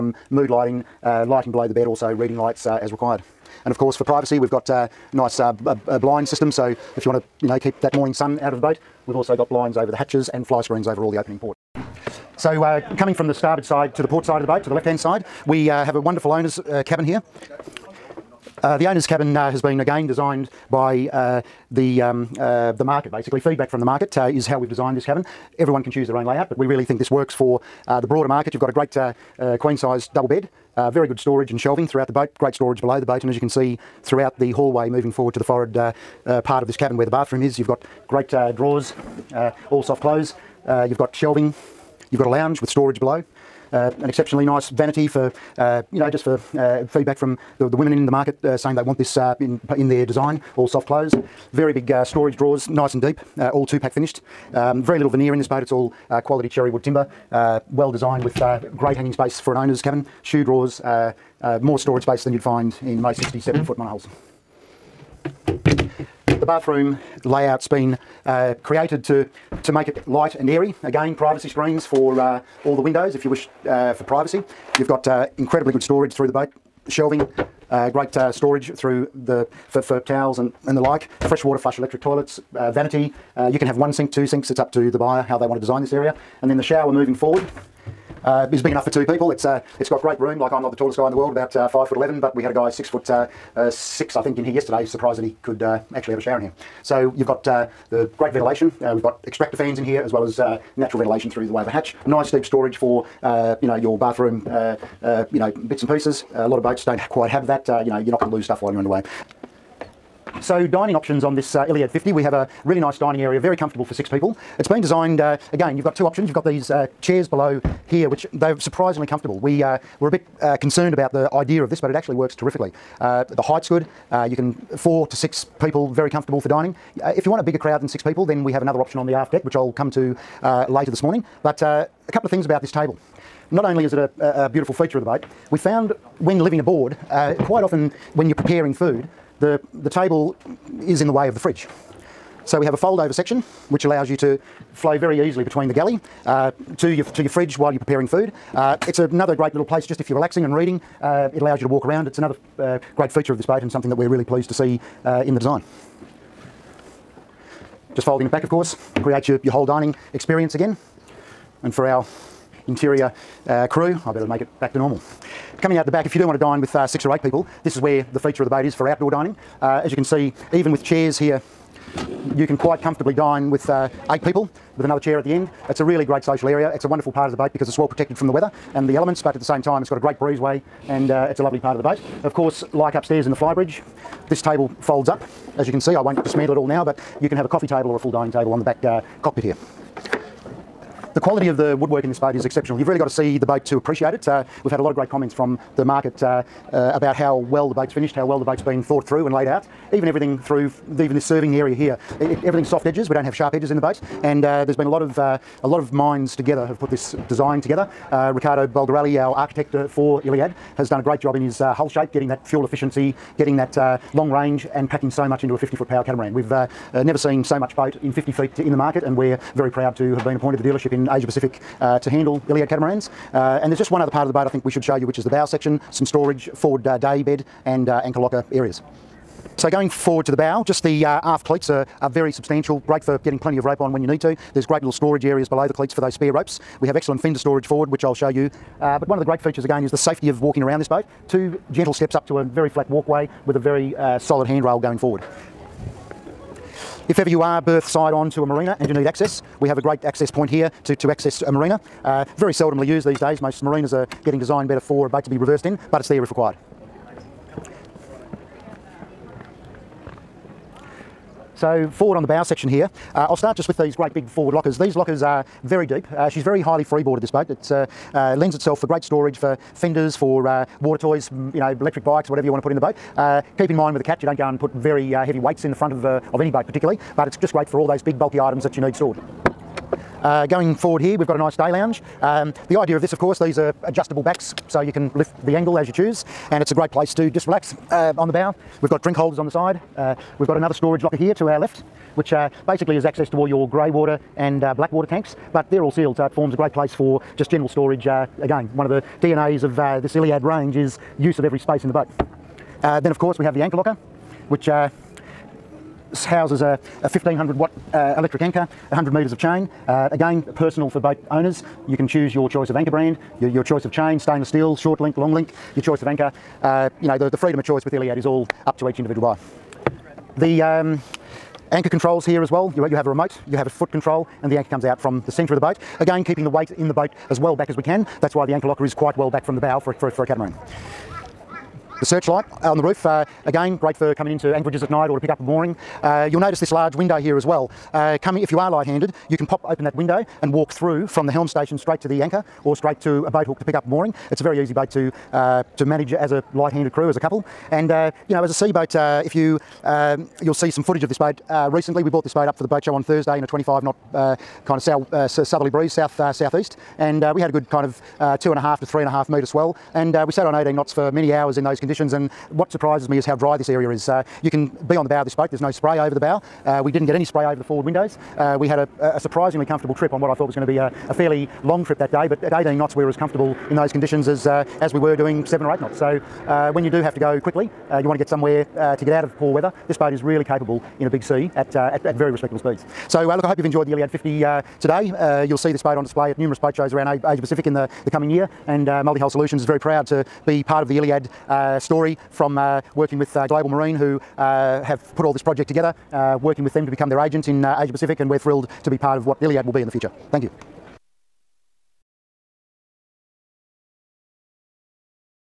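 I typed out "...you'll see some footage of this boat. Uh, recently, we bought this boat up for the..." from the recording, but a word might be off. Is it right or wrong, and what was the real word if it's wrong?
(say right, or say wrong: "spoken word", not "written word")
right.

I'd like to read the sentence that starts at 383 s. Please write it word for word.
So uh, look, I hope you've enjoyed the Iliad 50 uh, today.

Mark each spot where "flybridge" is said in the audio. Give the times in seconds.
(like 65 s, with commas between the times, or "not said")
183 s.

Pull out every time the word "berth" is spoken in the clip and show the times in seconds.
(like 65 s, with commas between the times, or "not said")
247 s.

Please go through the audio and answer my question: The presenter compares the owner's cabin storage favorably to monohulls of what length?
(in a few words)
67 foot.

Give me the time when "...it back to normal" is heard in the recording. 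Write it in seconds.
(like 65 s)
164 s.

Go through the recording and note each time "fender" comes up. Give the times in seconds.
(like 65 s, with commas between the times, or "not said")
237 s, 269 s.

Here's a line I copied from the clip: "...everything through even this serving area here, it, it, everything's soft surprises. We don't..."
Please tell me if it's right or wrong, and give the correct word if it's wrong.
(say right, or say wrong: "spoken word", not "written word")
wrong: "edges", not "surprises".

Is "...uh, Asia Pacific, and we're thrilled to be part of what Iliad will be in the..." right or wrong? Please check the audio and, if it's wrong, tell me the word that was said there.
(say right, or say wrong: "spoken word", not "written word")
right.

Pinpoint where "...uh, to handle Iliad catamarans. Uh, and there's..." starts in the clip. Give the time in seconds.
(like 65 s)
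221 s.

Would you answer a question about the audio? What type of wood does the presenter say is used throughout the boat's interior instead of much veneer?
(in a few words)
Cherry wood.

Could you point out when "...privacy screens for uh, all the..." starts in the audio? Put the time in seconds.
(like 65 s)
71 s.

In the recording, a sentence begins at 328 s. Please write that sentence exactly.
That's why the anchor locker is quite well back from the bow for, for, for a catamaran.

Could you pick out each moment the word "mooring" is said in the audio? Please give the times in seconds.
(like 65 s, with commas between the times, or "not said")
335 s, 343 s.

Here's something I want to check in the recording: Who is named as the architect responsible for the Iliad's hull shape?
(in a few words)
Riccardo Bulgarelli.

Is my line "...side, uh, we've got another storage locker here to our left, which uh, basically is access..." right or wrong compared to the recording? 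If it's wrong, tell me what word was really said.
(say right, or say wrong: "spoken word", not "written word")
right.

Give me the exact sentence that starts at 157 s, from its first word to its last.
Just folding it back of course, creates your, your whole dining experience again.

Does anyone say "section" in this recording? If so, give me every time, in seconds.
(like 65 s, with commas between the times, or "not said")
143 s, 225 s, 262 s.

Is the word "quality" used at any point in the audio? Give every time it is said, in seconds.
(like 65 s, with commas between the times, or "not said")
56 s, 191 s.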